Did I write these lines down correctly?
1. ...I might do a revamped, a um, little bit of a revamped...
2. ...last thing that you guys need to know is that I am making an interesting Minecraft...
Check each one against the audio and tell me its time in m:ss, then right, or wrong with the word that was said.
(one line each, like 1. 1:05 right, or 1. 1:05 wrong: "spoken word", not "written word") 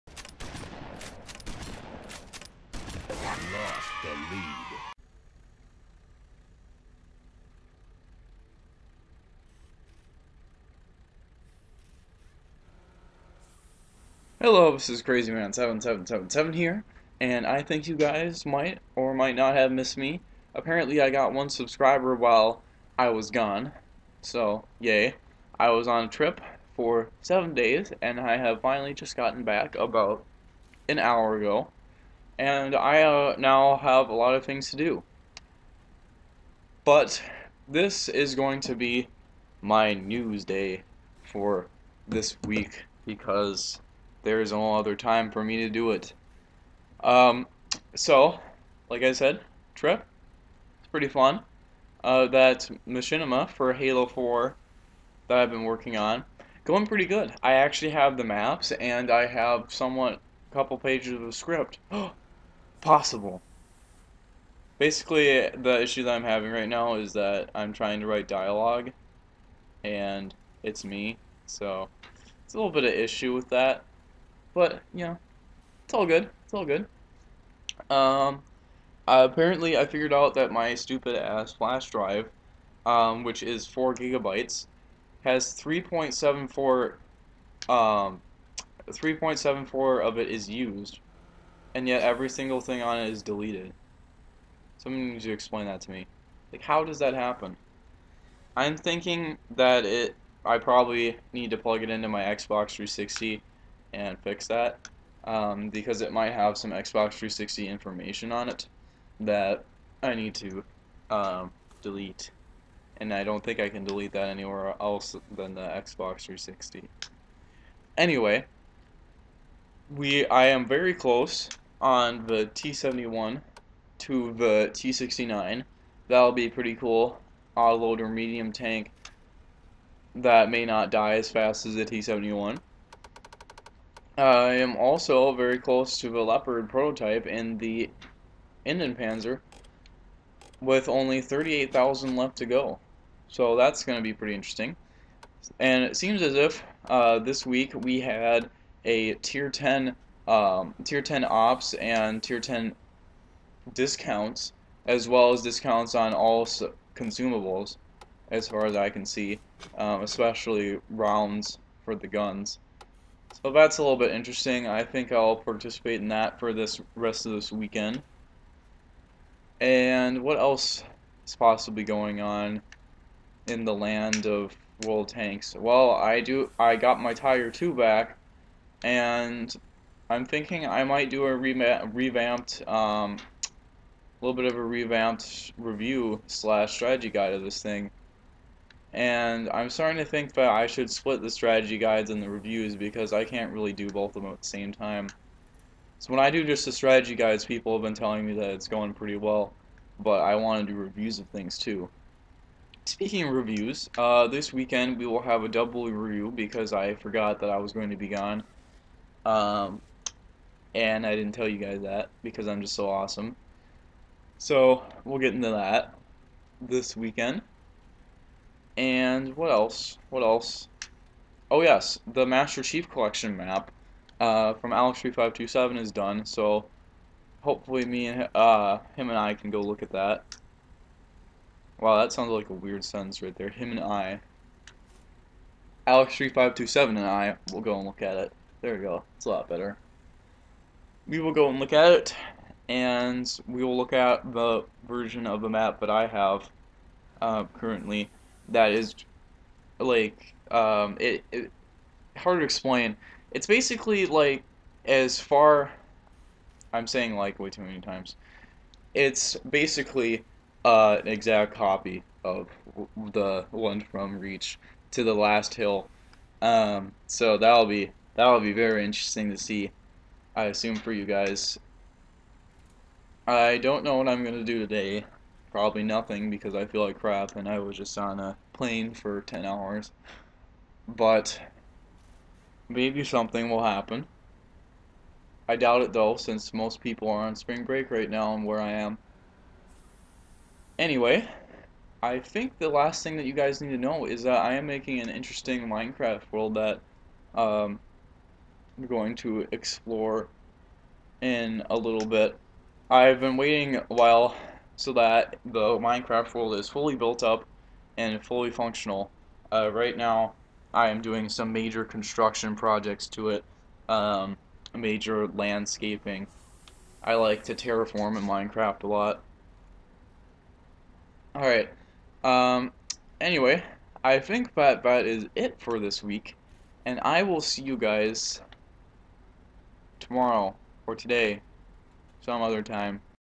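1. 3:00 right
2. 4:52 right.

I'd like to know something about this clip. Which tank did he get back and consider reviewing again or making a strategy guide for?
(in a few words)
Tiger 2.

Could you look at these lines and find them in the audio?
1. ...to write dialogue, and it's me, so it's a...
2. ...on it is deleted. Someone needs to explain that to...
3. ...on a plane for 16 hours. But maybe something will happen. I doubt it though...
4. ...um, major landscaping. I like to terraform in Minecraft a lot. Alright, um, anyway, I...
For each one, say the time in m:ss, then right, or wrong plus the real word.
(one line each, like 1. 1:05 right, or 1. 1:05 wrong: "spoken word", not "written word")
1. 1:07 right
2. 1:32 right
3. 4:37 wrong: "10", not "16"
4. 5:13 right.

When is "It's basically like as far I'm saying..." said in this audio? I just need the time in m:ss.
4:13.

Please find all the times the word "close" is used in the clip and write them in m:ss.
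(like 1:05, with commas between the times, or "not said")
2:00, 2:15.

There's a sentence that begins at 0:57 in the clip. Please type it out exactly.
I actually have the maps, and I have somewhat a couple pages of script.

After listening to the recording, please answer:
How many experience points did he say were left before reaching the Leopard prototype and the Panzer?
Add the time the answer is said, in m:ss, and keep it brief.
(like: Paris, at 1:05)
38,000, at 2:21.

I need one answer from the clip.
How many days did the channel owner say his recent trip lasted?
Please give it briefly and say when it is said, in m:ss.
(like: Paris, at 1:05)
7, at 0:27.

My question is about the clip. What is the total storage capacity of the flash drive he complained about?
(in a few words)
4 gigabytes.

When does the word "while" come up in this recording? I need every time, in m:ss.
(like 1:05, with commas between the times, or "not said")
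0:22, 5:03.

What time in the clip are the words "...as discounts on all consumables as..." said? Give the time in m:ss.
2:35.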